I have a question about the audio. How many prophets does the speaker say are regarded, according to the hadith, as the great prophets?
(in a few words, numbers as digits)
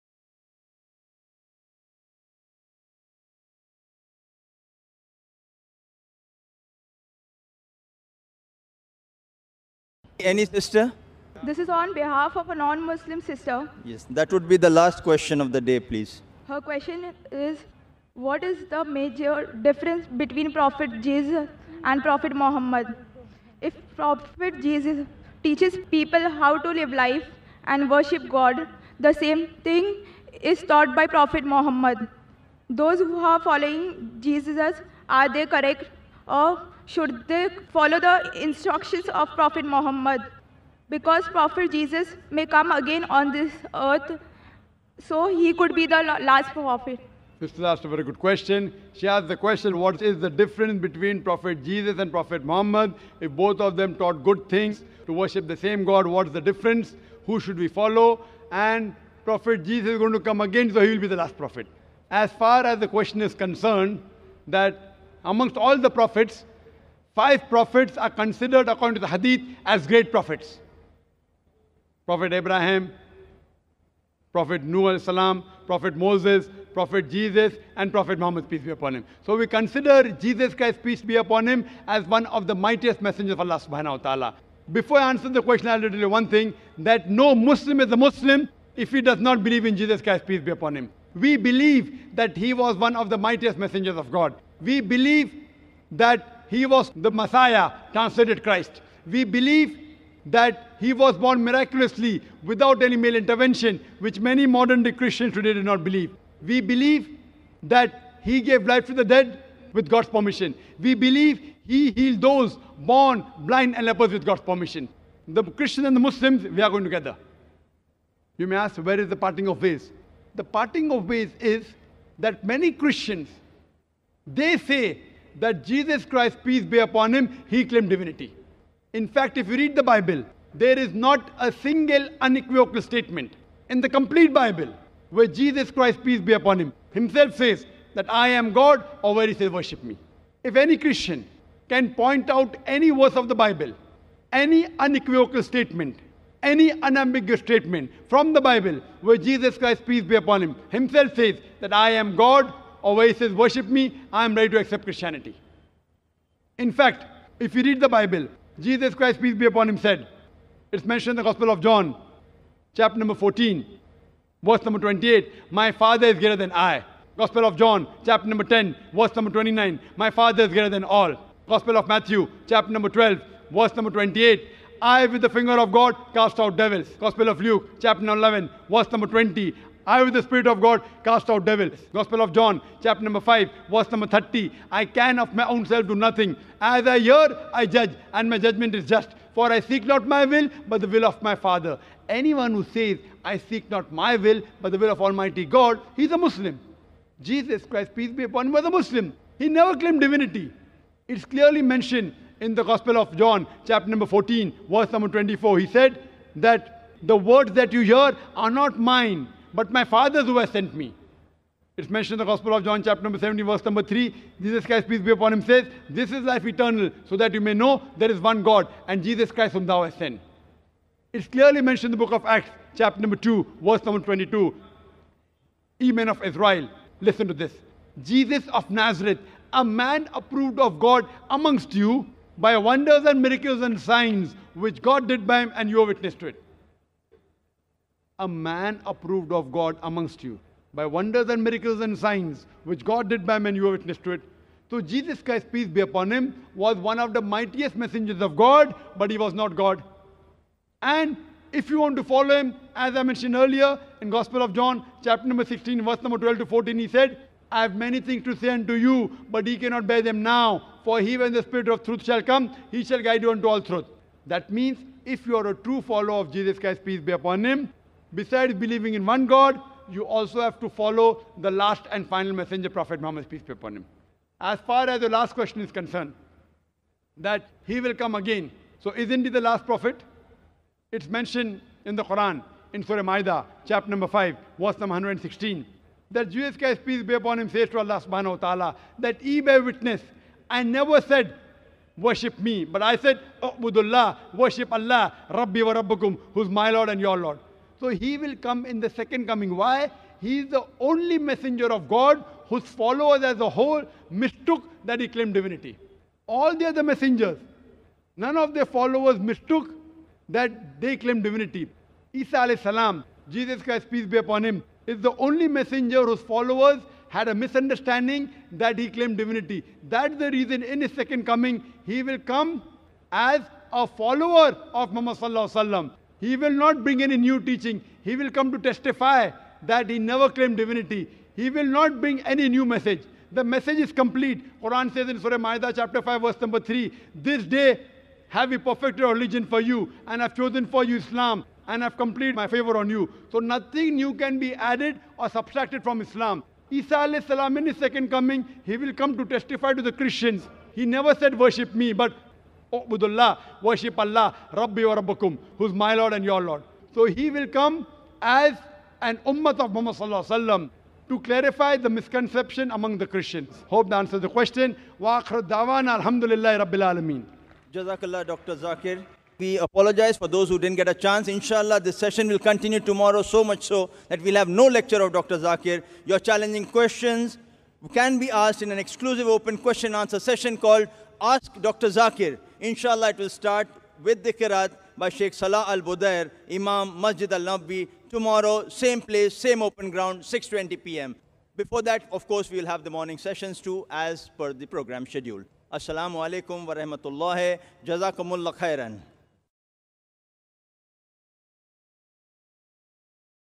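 5.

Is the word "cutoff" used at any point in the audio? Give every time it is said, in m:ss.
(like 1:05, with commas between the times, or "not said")
not said.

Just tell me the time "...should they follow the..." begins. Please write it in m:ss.
0:36.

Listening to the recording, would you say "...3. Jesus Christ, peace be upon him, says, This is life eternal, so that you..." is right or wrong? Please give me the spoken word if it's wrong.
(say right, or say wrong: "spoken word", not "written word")
right.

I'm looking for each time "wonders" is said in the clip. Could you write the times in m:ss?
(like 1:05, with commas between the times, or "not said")
3:52, 4:00.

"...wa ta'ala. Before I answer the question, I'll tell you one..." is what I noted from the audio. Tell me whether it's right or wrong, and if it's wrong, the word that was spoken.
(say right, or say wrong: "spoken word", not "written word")
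right.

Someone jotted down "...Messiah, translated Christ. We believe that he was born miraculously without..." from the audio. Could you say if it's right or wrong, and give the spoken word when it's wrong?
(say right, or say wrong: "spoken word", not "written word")
right.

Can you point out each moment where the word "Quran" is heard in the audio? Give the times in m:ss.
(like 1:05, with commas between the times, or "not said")
4:42, 5:34.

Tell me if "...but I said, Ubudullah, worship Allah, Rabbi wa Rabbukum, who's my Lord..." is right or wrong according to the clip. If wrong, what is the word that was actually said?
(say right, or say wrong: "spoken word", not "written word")
right.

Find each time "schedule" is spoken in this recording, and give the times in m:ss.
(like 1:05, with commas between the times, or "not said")
6:35.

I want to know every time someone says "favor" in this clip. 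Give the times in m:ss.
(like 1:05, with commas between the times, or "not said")
5:42.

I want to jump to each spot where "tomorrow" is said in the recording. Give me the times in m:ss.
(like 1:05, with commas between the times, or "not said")
6:12, 6:28.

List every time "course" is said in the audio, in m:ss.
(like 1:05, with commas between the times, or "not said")
6:32.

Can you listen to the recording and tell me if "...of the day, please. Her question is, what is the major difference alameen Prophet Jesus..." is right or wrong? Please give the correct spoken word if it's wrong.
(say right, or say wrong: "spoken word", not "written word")
wrong: "between", not "alameen".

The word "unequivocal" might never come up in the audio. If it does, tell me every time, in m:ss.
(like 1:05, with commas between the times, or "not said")
2:12, 2:24.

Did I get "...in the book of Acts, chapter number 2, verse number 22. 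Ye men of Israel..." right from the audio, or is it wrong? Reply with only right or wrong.
right.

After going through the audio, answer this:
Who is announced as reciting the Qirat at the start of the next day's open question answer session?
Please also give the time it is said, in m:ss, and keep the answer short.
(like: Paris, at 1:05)
Sheikh Salah Al Budair, at 6:25.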